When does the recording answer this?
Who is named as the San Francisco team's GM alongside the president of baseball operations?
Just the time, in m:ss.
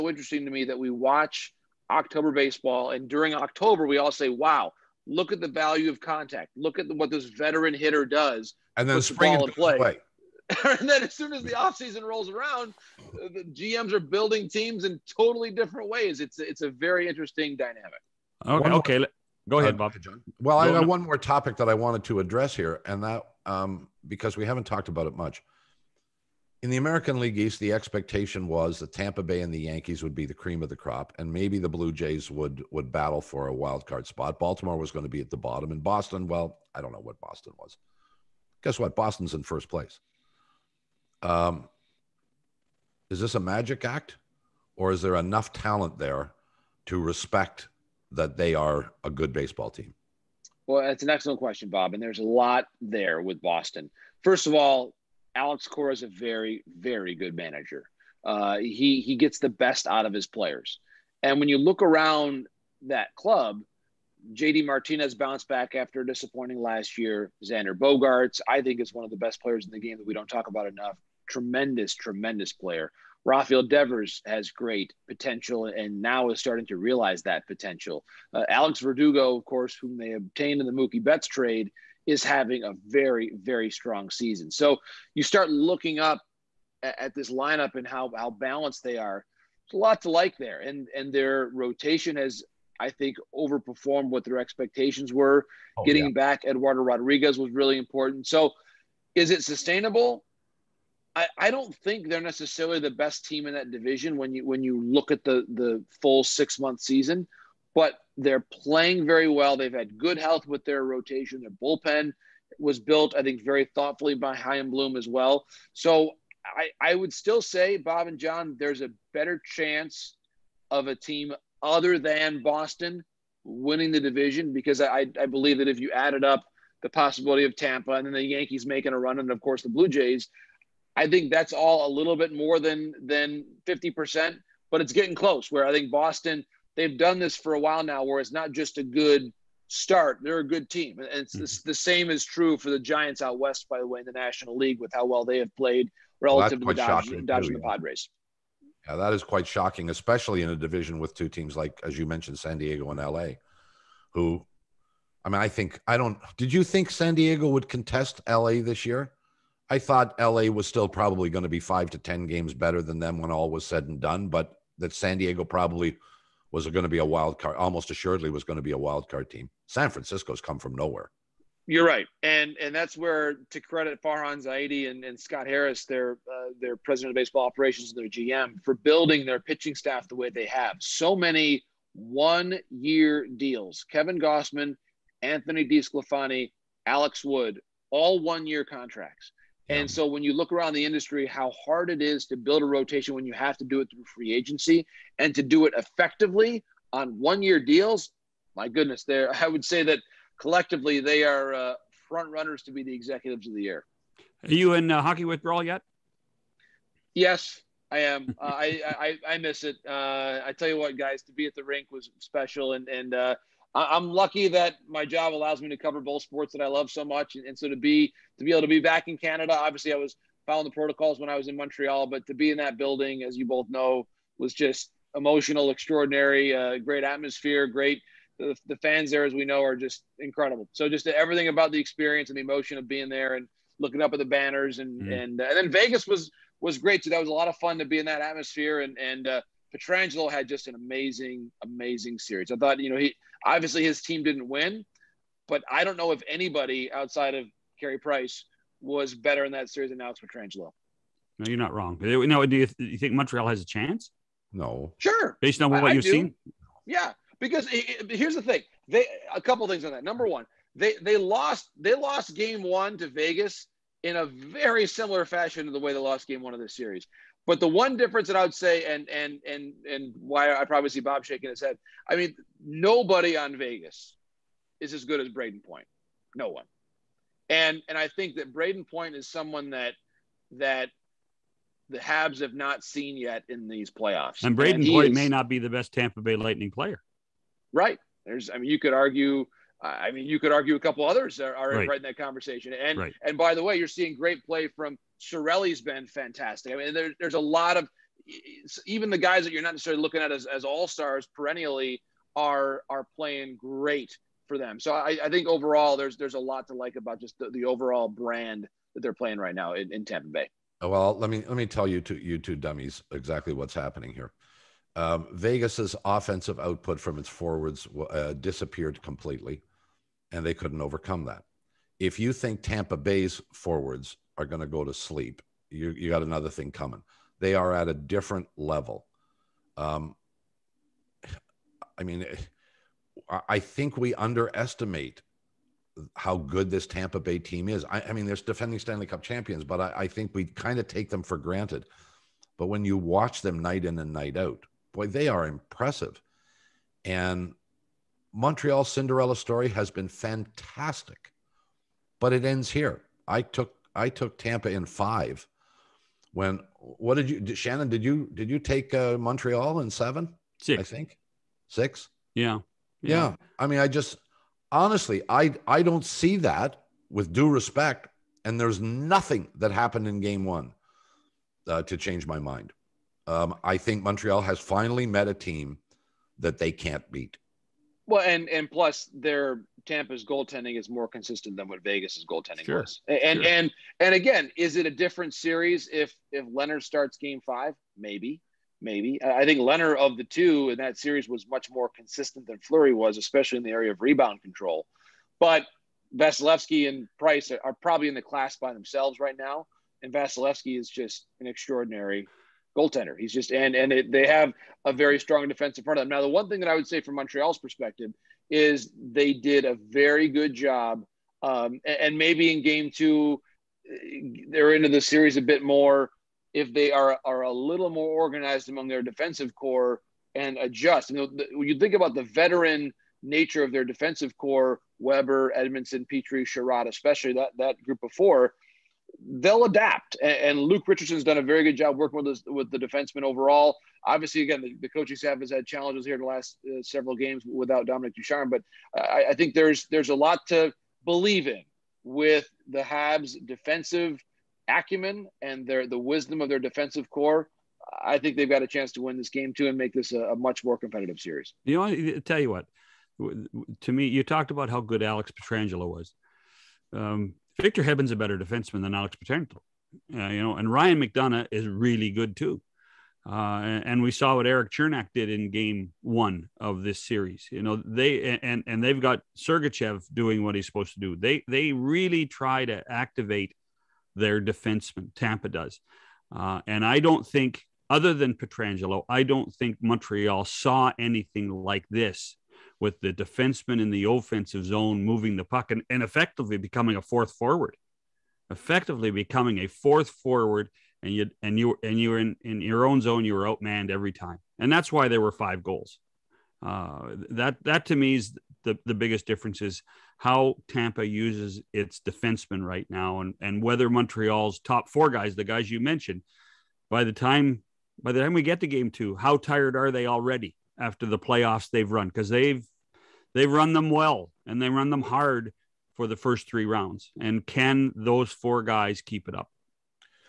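2:55.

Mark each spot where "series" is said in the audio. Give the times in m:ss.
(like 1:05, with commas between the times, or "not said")
4:02, 4:09, 4:26, 6:25, 6:30, 6:55, 7:31, 7:47.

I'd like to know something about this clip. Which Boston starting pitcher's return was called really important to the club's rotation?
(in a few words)
Eduardo Rodriguez.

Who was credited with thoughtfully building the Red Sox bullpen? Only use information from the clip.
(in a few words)
Chaim Bloom.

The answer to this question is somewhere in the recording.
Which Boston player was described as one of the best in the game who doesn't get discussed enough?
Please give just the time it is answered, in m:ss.
1:07.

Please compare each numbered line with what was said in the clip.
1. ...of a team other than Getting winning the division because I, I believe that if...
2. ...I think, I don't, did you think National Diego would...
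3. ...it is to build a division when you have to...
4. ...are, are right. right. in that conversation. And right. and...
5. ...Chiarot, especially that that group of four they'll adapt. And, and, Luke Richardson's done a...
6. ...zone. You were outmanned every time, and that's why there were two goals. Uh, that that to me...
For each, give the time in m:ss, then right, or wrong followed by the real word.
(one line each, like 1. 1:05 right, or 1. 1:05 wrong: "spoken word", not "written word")
1. 2:00 wrong: "Boston", not "Getting"
2. 2:35 wrong: "San", not "National"
3. 3:11 wrong: "rotation", not "division"
4. 4:51 right
5. 7:06 right
6. 8:13 wrong: "five", not "two".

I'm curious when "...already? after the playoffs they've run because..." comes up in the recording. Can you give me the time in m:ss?
8:30.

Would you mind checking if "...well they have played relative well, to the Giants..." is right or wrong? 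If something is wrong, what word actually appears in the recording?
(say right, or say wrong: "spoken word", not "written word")
wrong: "Dodgers", not "Giants".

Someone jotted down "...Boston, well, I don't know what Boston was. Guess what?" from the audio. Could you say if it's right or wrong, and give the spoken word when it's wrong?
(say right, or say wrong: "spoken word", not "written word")
right.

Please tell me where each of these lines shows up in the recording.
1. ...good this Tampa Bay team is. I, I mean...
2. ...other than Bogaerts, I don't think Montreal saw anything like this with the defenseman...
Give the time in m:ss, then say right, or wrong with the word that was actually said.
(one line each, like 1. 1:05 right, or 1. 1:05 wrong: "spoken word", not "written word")
1. 5:36 right
2. 7:57 wrong: "Pietrangelo", not "Bogaerts".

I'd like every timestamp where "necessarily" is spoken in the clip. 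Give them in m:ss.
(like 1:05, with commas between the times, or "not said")
1:42, 4:59.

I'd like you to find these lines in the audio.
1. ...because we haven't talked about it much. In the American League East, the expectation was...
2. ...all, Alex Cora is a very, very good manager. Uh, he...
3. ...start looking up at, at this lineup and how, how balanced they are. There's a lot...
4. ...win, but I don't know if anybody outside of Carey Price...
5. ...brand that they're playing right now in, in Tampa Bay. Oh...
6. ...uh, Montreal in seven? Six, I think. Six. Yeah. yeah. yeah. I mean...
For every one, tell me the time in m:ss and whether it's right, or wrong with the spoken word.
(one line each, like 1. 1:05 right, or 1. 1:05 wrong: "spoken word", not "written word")
1. 0:24 right
2. 0:54 right
3. 1:25 right
4. 4:04 right
5. 5:08 right
6. 5:58 right.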